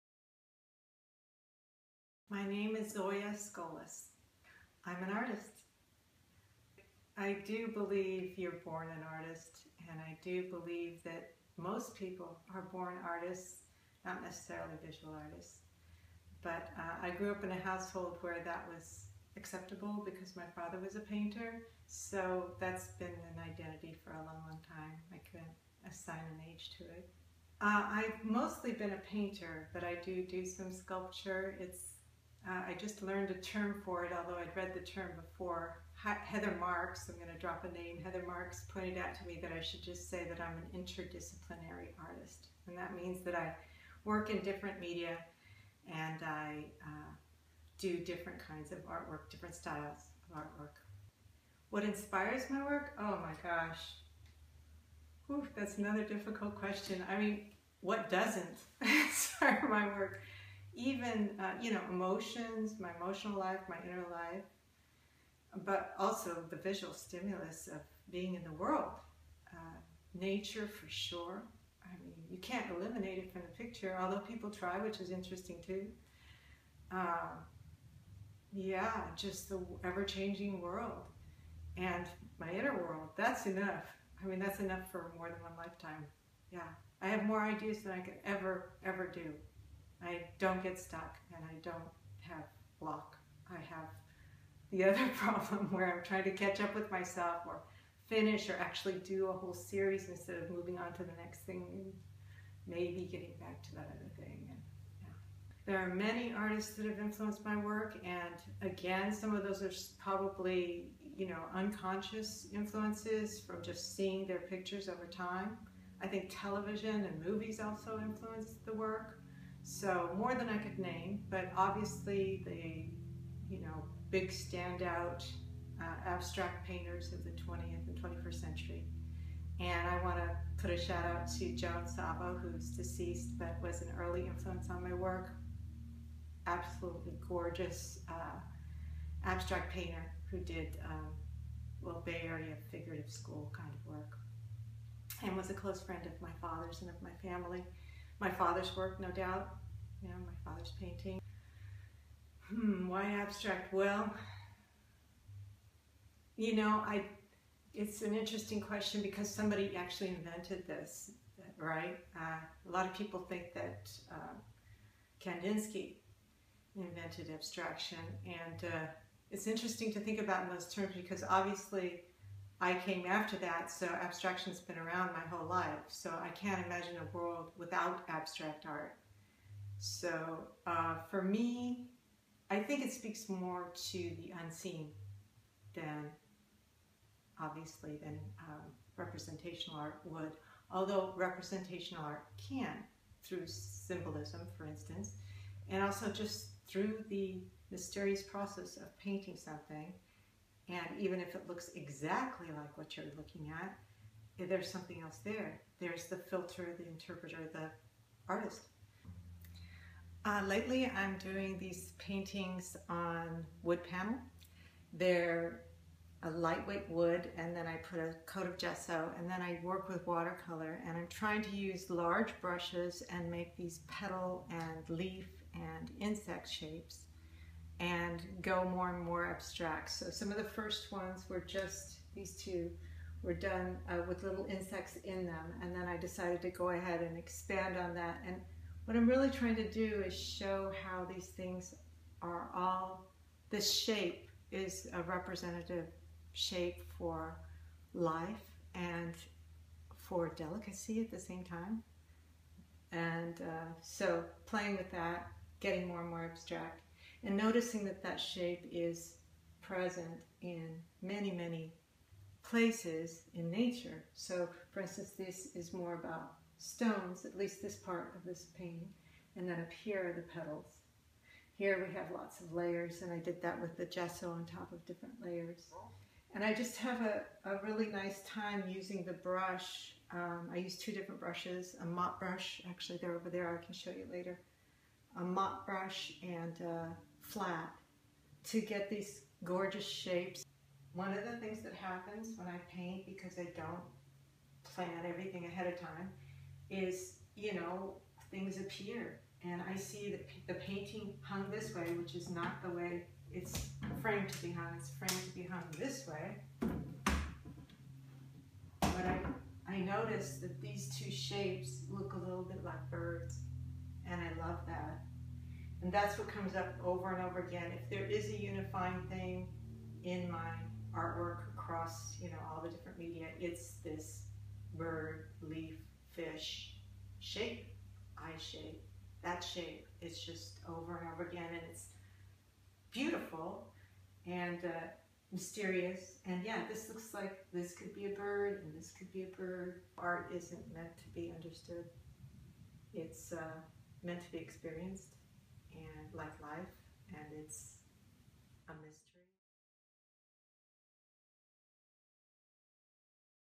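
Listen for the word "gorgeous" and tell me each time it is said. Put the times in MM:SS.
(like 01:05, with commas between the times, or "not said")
02:17, 04:49.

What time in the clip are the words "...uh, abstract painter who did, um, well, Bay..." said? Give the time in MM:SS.
02:18.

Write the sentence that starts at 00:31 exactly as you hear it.
It's uh, I just learned a term for it, although I'd read the term before.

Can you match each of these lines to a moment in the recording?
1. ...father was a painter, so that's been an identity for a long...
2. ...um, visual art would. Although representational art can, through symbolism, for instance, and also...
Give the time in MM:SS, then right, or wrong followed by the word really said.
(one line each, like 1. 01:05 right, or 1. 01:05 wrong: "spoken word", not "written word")
1. 00:20 right
2. 03:08 wrong: "representational", not "visual".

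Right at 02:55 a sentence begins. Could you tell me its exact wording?
So I can't imagine a world without abstract art.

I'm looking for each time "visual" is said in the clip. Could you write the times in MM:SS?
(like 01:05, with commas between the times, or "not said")
00:14, 01:06.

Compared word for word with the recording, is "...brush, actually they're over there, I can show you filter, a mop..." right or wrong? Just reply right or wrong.
wrong.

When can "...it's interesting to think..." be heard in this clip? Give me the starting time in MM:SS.
02:49.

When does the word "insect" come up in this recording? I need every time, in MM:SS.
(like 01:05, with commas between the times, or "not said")
03:45, 03:54.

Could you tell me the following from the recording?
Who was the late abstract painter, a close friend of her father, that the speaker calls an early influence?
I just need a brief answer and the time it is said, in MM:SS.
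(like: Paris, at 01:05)
Joan Savo, at 02:11.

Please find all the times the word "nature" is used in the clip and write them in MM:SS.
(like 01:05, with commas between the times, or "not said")
01:10, 04:23.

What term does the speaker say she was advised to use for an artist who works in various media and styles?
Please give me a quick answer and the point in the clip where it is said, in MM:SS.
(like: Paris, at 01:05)
interdisciplinary artist, at 00:40.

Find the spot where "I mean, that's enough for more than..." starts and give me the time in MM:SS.
01:24.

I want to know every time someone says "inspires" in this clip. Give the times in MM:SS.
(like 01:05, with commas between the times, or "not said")
00:51, 00:58.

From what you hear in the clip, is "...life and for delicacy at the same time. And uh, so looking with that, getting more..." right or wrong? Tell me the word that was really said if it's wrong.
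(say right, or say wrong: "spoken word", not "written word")
wrong: "playing", not "looking".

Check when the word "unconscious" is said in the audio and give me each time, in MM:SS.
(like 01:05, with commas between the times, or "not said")
01:51.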